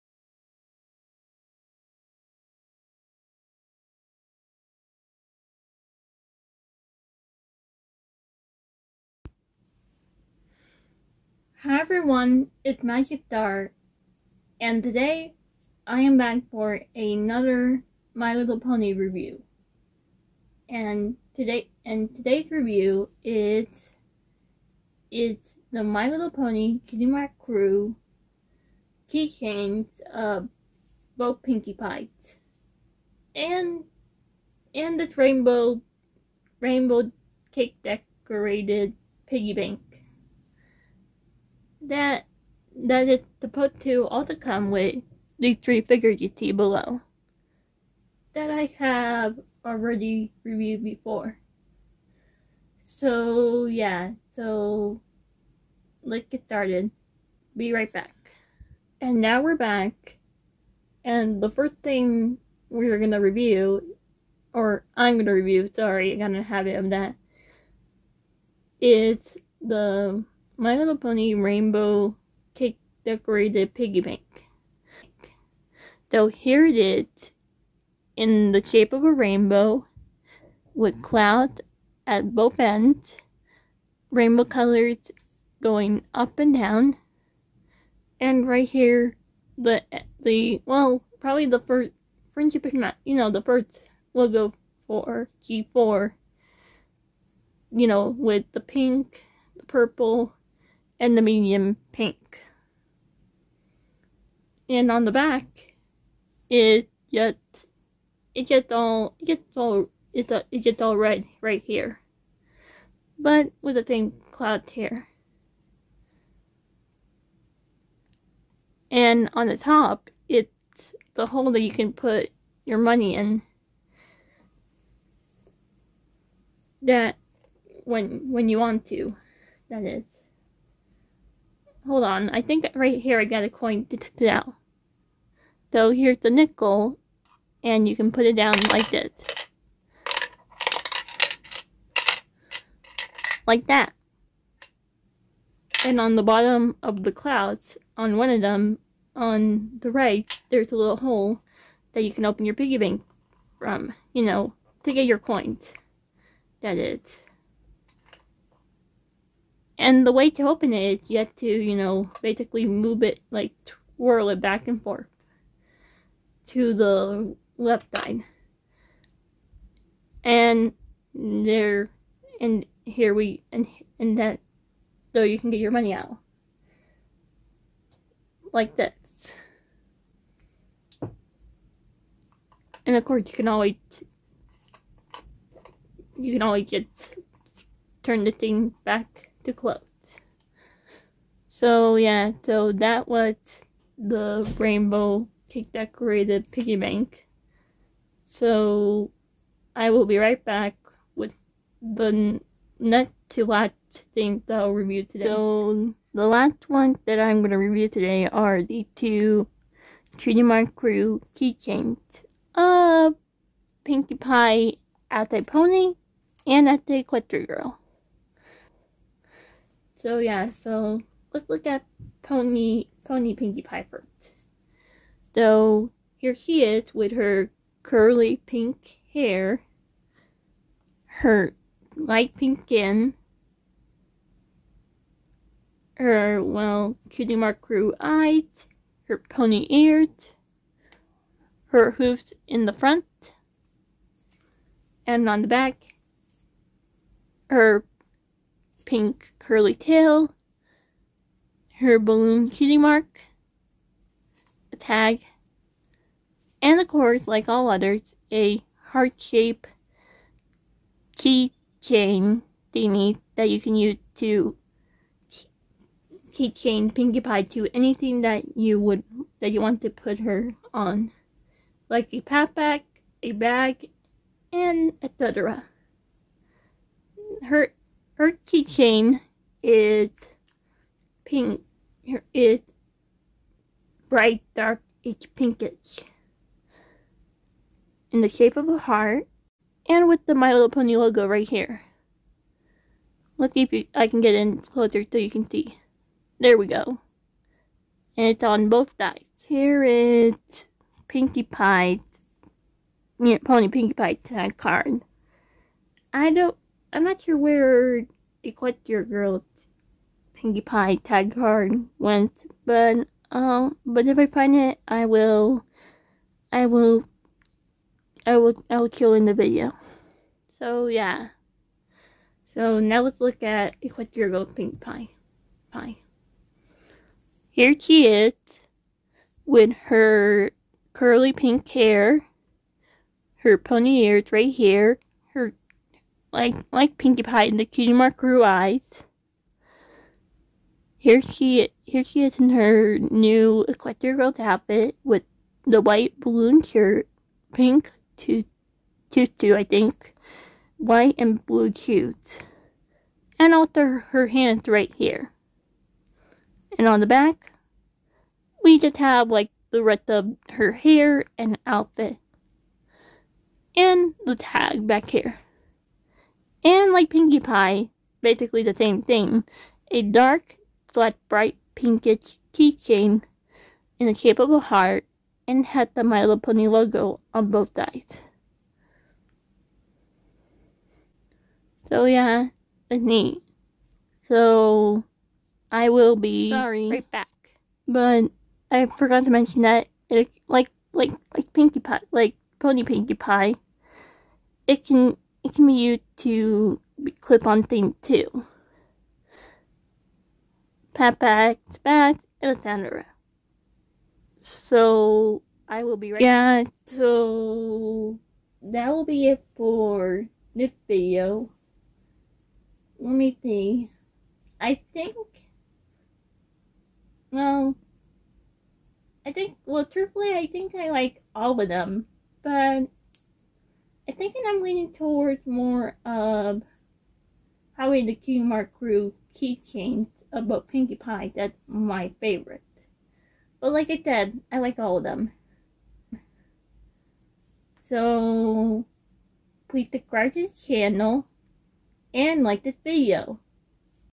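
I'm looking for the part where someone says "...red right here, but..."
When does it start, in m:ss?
1:50.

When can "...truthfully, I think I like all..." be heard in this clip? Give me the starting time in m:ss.
6:59.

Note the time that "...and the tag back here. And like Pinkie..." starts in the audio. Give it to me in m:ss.
6:03.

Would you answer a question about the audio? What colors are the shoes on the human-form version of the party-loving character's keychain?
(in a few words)
white and blue.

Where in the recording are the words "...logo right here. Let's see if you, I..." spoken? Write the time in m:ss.
4:50.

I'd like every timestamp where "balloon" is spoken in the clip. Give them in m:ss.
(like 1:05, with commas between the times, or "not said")
4:11, 5:46.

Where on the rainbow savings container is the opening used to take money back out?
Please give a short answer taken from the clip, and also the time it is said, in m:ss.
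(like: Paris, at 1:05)
bottom of the clouds, at 2:26.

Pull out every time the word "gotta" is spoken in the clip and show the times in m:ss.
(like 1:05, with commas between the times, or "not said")
1:06.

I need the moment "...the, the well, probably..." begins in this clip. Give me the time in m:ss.
1:29.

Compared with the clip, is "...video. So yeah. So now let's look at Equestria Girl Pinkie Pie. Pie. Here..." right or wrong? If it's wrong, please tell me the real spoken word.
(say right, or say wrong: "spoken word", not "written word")
right.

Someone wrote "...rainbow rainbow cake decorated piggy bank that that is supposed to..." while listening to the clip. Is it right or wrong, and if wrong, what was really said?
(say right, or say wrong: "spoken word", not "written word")
right.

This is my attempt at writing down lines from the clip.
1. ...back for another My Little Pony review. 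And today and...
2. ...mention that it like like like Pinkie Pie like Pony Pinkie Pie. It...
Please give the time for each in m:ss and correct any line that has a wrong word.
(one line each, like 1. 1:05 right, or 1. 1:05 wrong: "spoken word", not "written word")
1. 0:16 right
2. 6:29 right.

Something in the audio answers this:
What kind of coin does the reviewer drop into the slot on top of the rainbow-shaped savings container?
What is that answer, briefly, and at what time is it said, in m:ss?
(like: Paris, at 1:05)
nickel, at 2:16.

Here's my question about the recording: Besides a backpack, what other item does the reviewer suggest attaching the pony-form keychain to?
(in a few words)
a bag.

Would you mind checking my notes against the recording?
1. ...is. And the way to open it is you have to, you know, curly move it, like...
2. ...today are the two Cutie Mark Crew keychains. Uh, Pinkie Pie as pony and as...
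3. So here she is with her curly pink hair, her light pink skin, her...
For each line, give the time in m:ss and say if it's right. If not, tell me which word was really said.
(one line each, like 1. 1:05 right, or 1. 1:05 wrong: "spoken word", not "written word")
1. 2:36 wrong: "basically", not "curly"
2. 3:27 right
3. 3:45 right.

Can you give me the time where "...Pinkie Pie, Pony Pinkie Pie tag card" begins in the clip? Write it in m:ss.
5:01.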